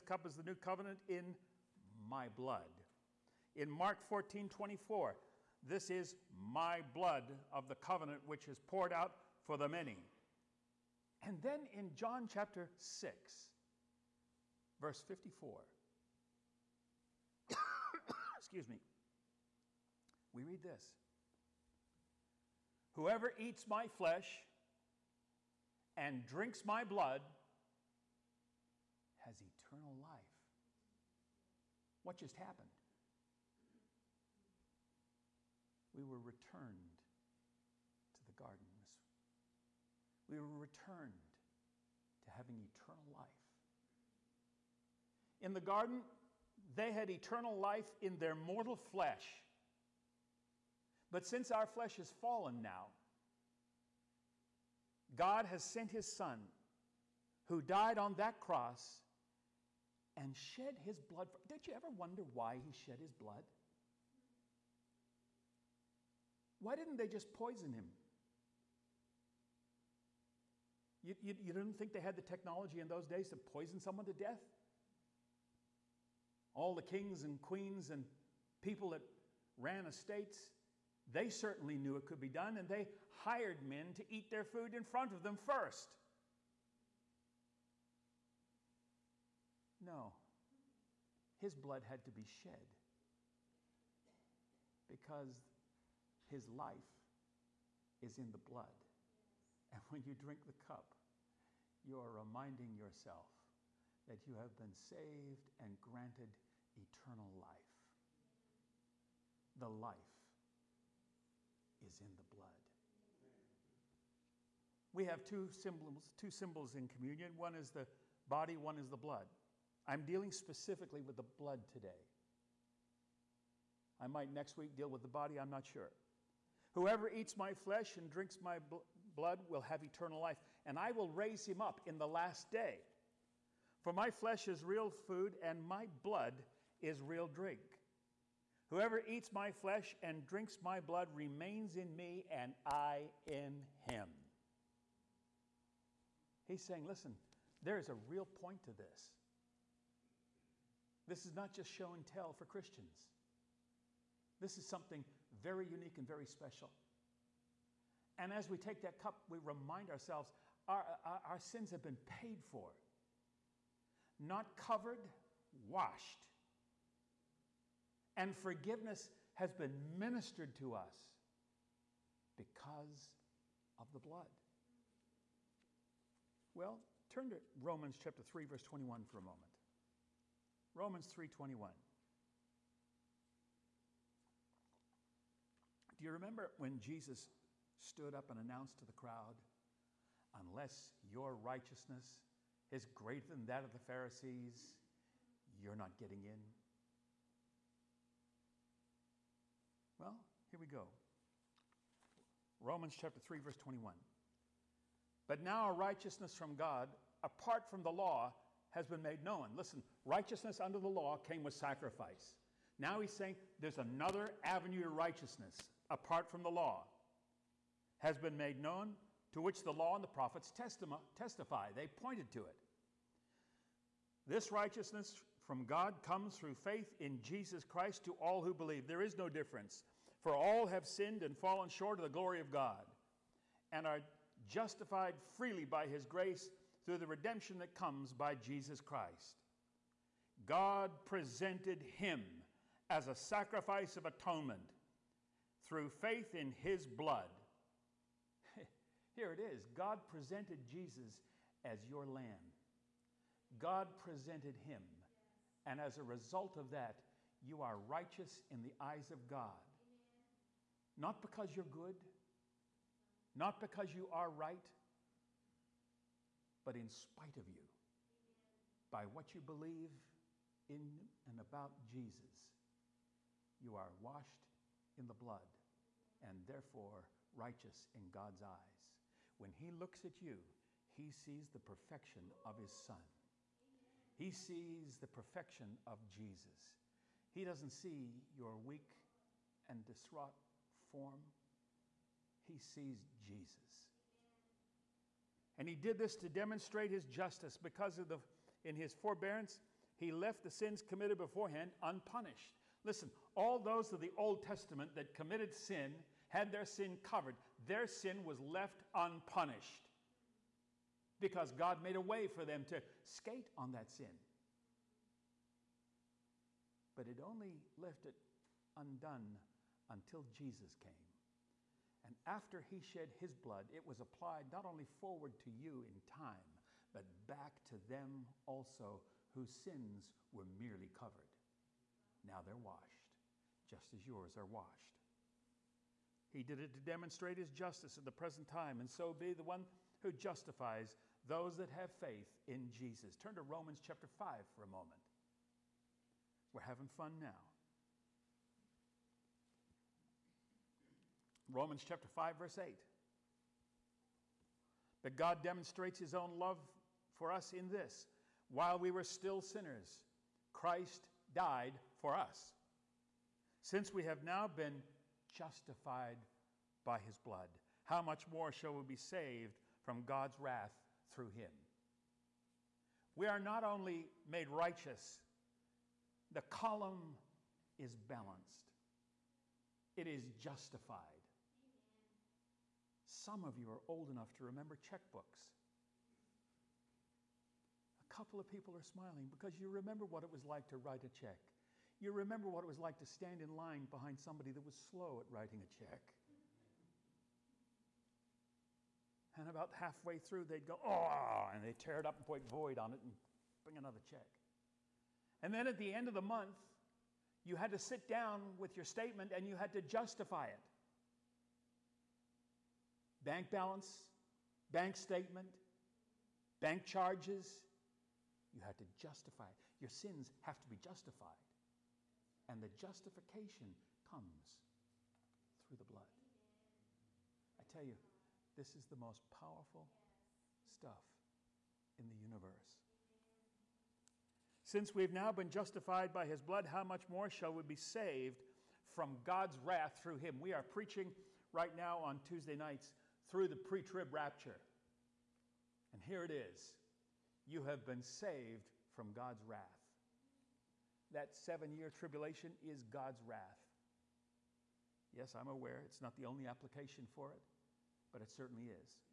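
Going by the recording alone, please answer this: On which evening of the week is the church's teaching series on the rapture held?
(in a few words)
Tuesday.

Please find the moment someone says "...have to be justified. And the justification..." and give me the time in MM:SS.
07:00.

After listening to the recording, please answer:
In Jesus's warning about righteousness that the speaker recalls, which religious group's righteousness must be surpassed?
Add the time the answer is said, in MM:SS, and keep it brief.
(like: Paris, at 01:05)
The Pharisees, at 03:13.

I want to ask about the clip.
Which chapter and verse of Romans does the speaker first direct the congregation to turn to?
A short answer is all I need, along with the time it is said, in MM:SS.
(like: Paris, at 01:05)
Romans 3:21, at 03:00.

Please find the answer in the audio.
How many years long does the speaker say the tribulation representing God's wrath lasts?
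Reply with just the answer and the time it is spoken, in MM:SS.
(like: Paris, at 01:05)
7, at 07:31.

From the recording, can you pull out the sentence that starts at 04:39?
When he looks at you, he sees the perfection of his son.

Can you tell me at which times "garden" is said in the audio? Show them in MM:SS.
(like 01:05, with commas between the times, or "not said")
00:38, 00:45.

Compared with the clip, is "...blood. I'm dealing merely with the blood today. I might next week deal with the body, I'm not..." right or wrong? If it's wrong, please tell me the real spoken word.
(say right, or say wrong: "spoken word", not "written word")
wrong: "specifically", not "merely".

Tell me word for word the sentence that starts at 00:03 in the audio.
In Mark 14 24, this is my blood of the covenant which is poured out for the many.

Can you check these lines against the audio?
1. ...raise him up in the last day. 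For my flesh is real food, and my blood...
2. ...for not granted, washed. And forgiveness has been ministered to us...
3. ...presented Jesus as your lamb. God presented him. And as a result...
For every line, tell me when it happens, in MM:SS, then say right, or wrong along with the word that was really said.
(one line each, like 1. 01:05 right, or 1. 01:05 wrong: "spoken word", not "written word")
1. 02:11 right
2. 02:42 wrong: "covered", not "granted"
3. 04:10 right.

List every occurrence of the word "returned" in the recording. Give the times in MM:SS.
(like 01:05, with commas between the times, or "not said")
00:36, 00:40.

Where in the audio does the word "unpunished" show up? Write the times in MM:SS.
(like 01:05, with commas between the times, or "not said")
05:01, 05:08.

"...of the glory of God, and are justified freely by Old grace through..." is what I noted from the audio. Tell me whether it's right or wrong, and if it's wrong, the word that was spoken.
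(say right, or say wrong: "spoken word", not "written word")
wrong: "His", not "Old".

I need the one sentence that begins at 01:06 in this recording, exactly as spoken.
Why didn't they just poison him?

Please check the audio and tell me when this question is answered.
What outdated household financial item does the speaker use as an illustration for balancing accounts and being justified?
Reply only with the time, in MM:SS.
06:24.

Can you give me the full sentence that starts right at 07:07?
I tell you, this is the most powerful stuff in the universe.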